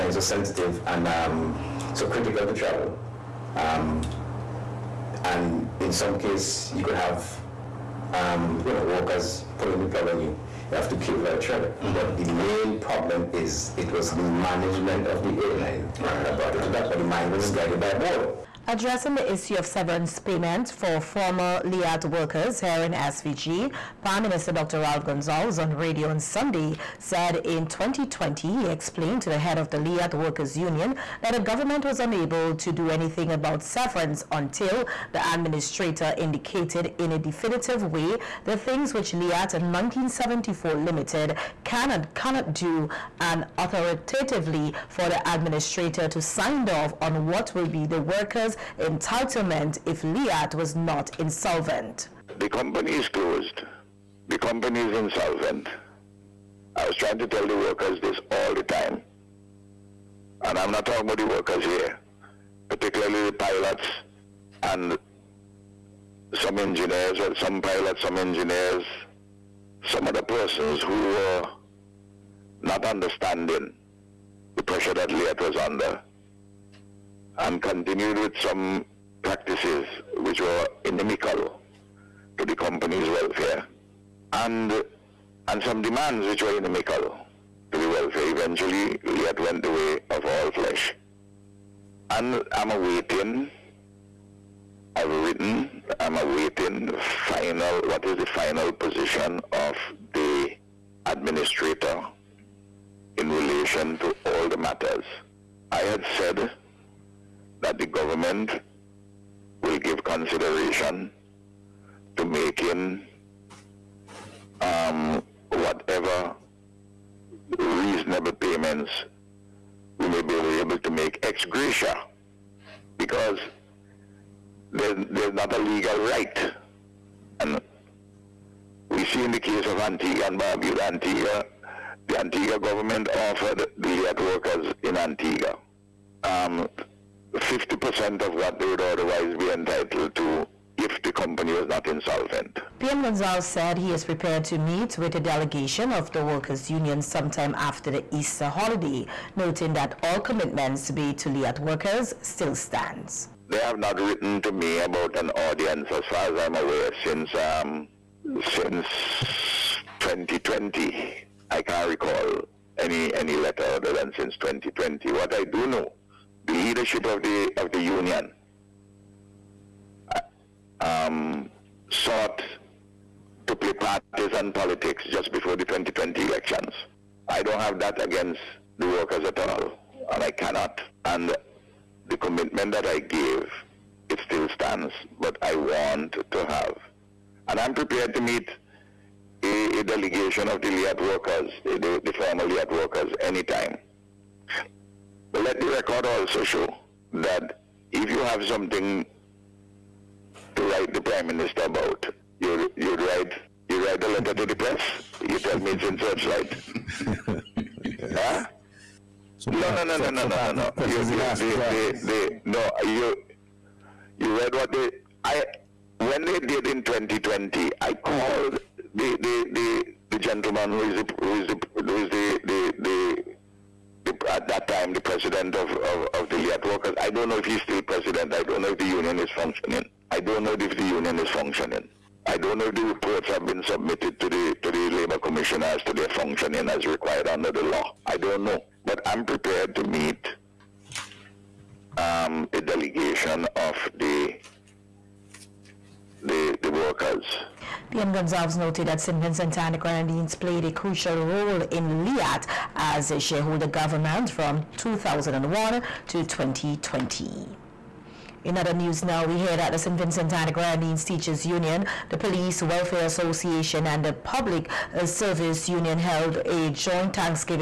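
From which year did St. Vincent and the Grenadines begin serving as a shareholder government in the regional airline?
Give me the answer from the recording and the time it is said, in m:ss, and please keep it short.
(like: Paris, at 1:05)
2001, at 4:14.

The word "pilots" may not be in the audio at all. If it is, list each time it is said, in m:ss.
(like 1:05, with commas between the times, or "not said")
1:03, 1:07.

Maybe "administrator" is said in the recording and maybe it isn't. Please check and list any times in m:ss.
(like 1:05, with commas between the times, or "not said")
0:35, 0:45, 1:41.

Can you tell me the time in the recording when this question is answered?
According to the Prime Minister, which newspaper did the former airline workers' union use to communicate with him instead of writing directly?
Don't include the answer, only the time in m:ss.
3:25.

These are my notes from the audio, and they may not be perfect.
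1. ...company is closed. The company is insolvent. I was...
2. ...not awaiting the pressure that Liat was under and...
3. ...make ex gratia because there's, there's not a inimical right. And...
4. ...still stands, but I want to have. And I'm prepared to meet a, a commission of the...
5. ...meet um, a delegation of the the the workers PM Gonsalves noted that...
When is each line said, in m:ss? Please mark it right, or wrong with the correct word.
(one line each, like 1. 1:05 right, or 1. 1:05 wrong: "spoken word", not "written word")
1. 0:52 right
2. 1:12 wrong: "understanding", not "awaiting"
3. 2:00 wrong: "legal", not "inimical"
4. 3:04 wrong: "delegation", not "commission"
5. 3:59 right.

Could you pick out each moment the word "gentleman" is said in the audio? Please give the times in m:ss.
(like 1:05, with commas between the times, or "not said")
3:40.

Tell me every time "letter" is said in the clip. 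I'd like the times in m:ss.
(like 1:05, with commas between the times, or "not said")
2:43, 3:24.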